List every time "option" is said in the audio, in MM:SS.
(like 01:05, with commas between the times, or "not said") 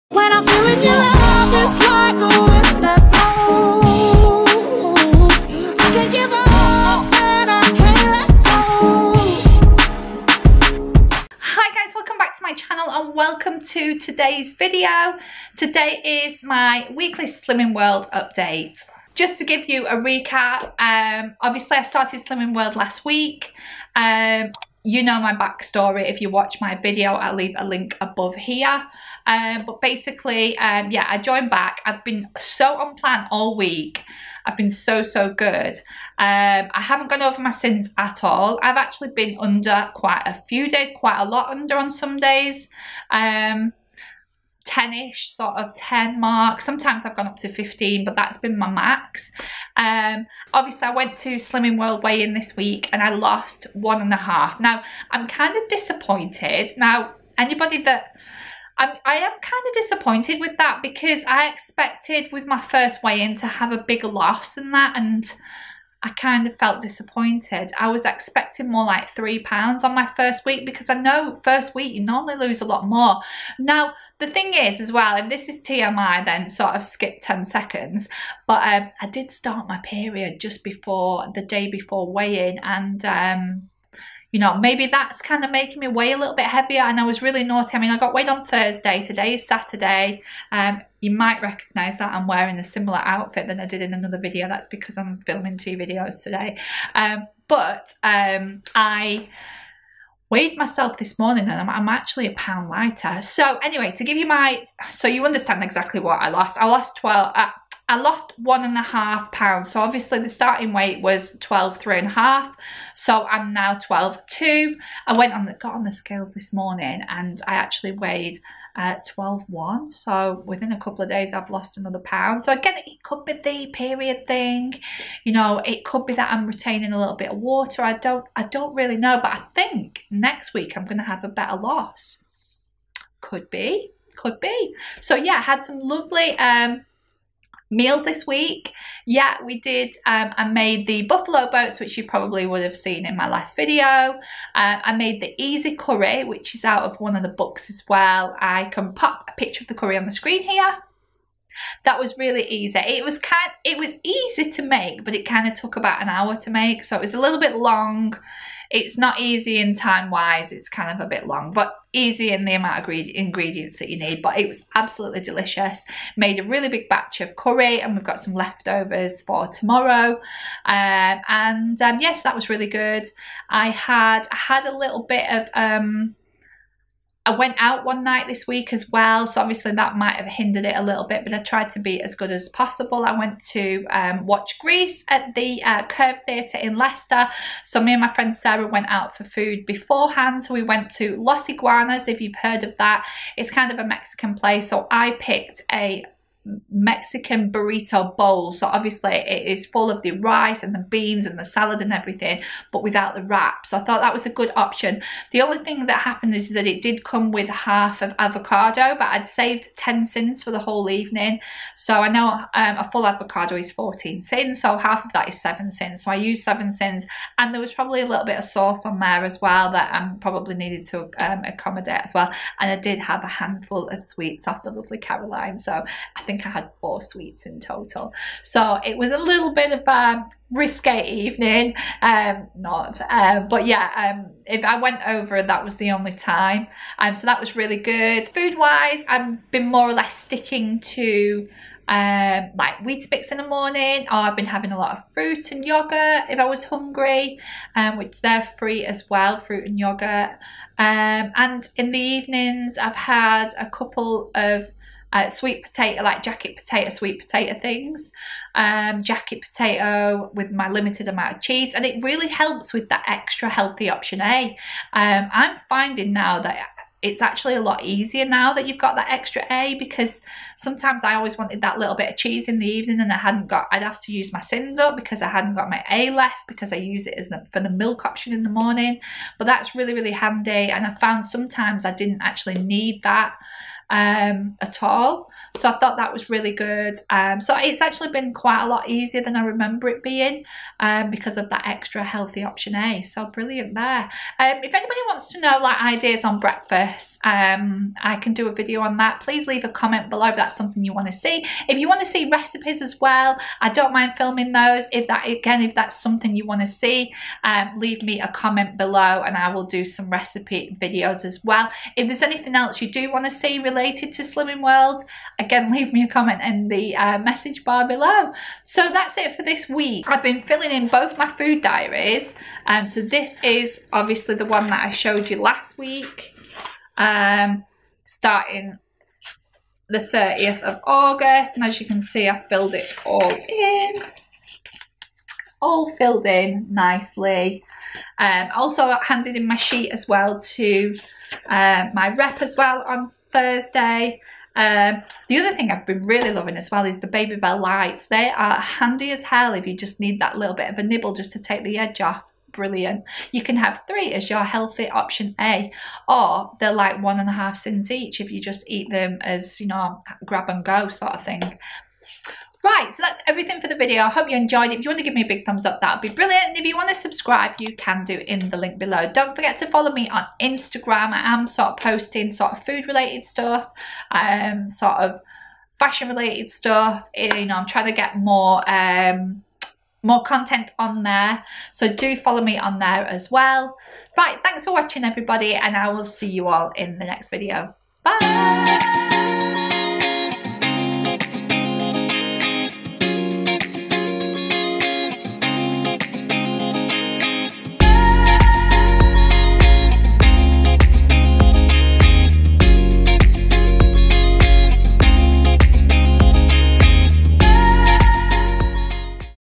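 03:24, 04:23, 04:38, 04:52, 05:54.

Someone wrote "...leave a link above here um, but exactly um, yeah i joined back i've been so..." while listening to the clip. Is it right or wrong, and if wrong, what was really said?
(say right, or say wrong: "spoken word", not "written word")
wrong: "basically", not "exactly".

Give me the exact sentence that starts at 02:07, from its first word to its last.
I don't, I don't really know, but I think next week I'm going to have a better loss.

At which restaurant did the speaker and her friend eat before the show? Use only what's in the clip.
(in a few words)
Los Iguanas.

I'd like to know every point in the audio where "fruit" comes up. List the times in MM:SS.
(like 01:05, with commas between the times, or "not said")
04:05, 04:09.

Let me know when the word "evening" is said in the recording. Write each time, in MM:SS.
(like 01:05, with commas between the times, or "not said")
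03:30, 03:51, 04:11, 04:32.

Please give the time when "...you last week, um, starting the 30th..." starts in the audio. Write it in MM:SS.
05:25.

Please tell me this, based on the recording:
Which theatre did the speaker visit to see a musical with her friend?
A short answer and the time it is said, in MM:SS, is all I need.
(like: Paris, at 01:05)
Curve Theatre, at 03:05.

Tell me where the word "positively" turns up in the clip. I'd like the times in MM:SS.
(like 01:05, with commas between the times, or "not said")
not said.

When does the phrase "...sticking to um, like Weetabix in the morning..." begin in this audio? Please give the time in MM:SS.
04:00.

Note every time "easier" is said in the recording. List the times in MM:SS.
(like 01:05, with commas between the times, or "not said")
04:27, 04:48.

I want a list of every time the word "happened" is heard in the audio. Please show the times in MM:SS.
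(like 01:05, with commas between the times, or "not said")
03:26.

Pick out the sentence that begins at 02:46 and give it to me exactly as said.
Made a really big batch of curry, and we've got some leftovers for tomorrow.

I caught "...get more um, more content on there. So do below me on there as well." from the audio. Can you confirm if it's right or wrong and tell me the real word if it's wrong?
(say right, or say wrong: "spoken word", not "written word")
wrong: "follow", not "below".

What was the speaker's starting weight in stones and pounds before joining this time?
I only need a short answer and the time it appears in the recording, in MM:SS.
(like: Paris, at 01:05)
12 stone 3.5, at 01:51.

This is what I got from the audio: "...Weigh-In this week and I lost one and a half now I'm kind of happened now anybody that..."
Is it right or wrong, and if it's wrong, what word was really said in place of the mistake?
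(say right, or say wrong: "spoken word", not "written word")
wrong: "disappointed", not "happened".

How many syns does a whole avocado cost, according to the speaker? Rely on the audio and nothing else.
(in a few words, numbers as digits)
14.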